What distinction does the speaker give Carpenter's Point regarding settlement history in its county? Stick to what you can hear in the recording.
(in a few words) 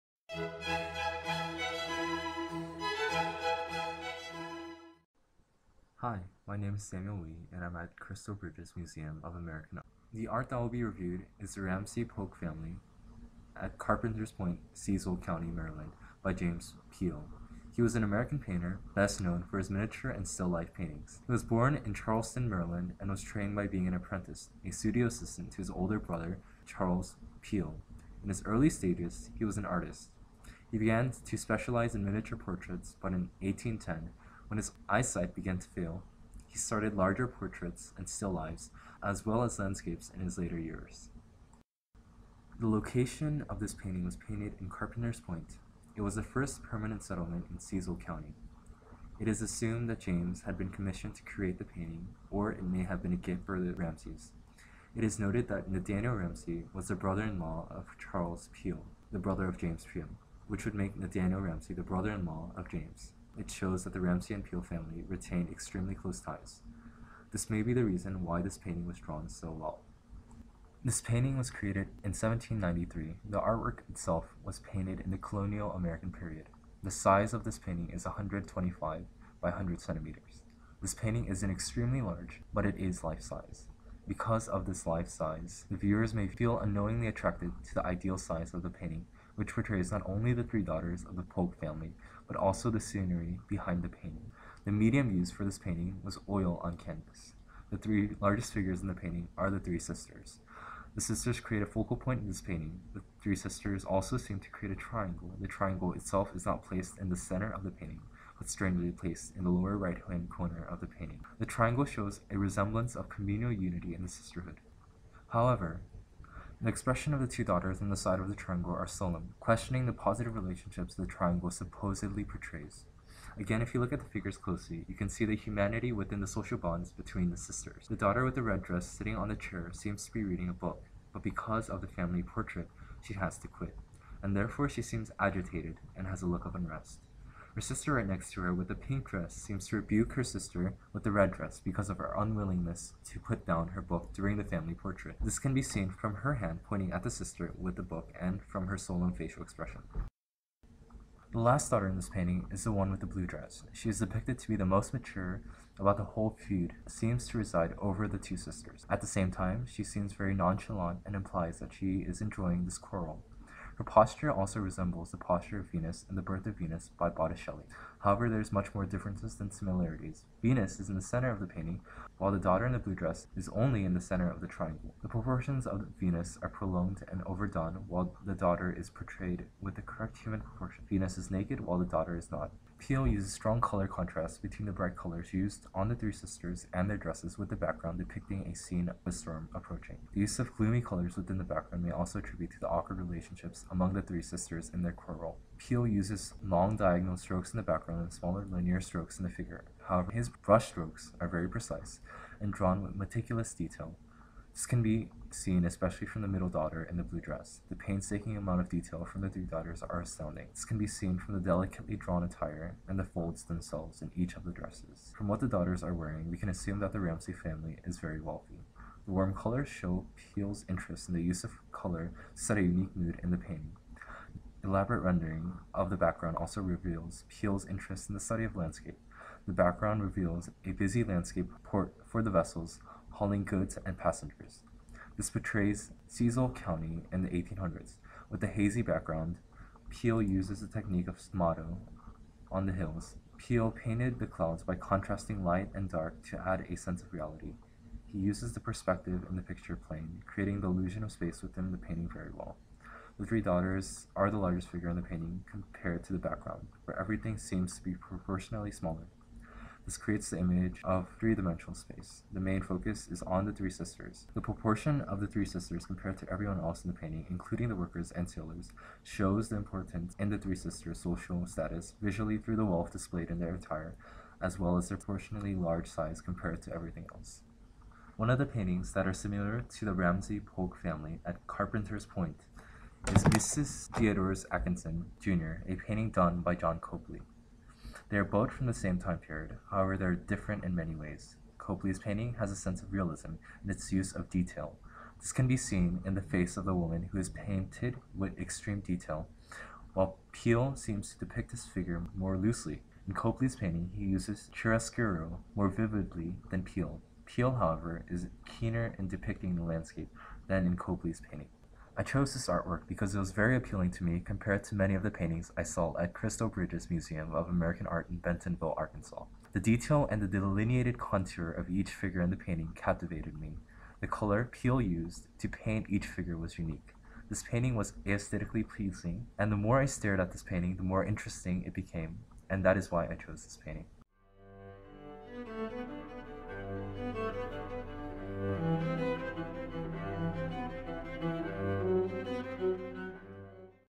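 First permanent settlement.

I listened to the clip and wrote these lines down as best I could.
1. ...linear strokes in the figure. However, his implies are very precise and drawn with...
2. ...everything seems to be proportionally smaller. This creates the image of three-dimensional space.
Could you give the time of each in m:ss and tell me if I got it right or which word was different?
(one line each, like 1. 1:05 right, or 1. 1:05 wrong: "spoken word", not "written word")
1. 3:18 wrong: "brushstrokes", not "implies"
2. 4:16 right.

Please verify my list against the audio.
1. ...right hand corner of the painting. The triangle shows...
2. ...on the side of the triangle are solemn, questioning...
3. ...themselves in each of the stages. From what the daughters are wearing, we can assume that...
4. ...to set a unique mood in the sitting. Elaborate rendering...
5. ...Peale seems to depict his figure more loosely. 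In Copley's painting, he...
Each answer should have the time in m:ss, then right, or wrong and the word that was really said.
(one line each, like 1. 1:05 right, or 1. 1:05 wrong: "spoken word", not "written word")
1. 1:49 right
2. 1:57 right
3. 3:33 wrong: "dresses", not "stages"
4. 3:42 wrong: "painting", not "sitting"
5. 5:00 right.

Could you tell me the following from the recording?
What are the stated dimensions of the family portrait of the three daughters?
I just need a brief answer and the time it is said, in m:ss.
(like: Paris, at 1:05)
125 by 100 centimeters, at 1:18.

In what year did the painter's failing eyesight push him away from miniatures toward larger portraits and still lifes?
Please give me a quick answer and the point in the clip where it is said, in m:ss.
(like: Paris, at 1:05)
1810, at 0:33.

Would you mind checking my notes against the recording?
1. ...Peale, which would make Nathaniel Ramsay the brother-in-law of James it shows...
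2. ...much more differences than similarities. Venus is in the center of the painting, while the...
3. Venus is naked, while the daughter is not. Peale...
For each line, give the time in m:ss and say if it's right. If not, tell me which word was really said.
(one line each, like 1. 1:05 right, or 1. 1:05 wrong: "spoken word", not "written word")
1. 0:59 right
2. 2:48 right
3. 3:00 right.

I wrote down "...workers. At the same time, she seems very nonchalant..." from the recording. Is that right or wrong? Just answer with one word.
wrong.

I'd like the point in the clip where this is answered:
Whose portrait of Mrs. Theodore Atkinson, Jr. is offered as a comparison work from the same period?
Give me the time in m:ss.
4:46.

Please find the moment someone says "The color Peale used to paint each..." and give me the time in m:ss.
5:23.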